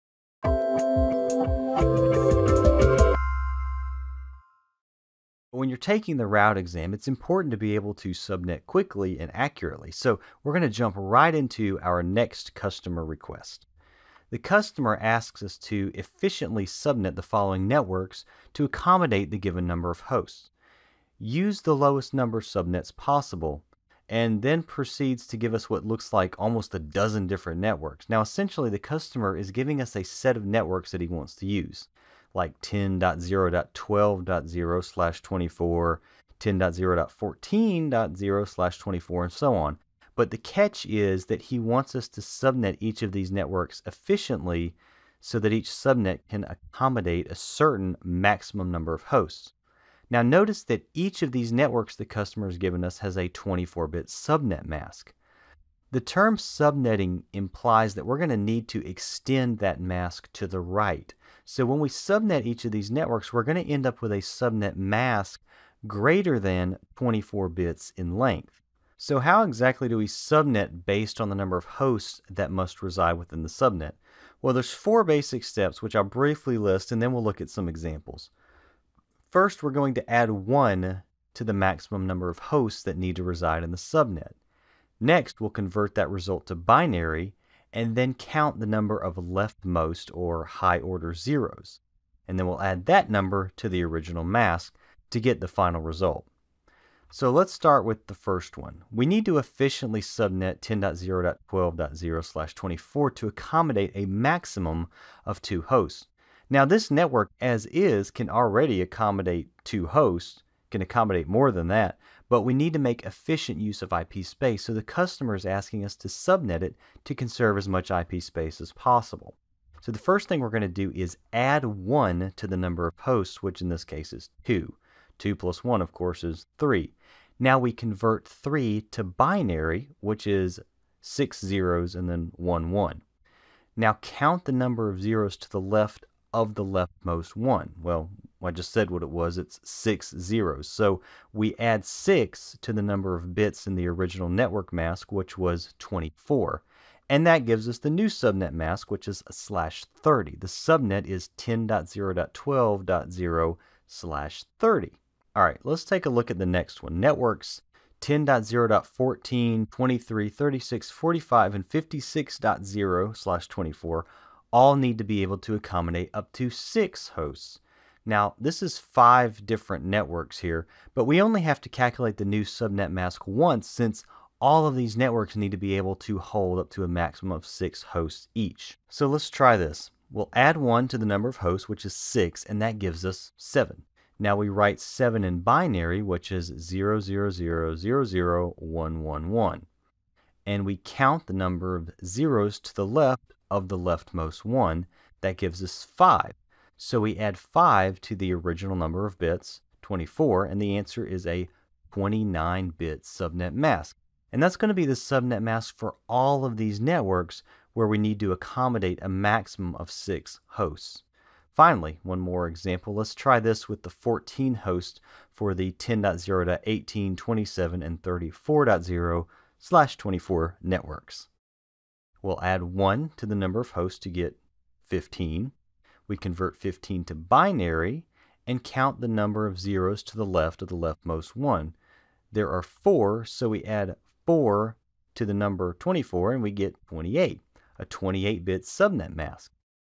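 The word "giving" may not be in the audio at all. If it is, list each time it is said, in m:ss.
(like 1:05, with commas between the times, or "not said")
0:29.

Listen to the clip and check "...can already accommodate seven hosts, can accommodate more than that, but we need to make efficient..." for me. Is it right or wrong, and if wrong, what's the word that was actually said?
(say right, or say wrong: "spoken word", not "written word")
wrong: "two", not "seven".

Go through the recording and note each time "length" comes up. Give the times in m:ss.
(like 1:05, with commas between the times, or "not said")
1:08.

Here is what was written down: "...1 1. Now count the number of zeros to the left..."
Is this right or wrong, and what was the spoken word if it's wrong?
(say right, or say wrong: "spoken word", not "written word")
right.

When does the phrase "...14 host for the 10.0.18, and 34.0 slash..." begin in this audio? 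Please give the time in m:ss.
3:33.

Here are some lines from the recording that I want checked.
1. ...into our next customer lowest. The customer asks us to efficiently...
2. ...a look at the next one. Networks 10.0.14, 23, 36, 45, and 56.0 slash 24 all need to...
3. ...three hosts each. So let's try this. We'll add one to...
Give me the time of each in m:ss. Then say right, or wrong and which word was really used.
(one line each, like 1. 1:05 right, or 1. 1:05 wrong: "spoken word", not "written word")
1. 0:11 wrong: "request", not "lowest"
2. 2:36 right
3. 2:57 wrong: "six", not "three".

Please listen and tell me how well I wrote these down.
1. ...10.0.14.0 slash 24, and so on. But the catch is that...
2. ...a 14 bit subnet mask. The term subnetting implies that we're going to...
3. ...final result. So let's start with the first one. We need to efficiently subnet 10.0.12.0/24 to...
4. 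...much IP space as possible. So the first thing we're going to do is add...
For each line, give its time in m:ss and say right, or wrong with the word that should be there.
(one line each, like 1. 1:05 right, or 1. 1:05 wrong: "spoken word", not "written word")
1. 0:36 right
2. 0:53 wrong: "24", not "14"
3. 1:35 right
4. 1:57 right.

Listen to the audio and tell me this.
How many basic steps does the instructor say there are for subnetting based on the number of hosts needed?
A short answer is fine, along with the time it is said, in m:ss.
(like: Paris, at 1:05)
4, at 1:14.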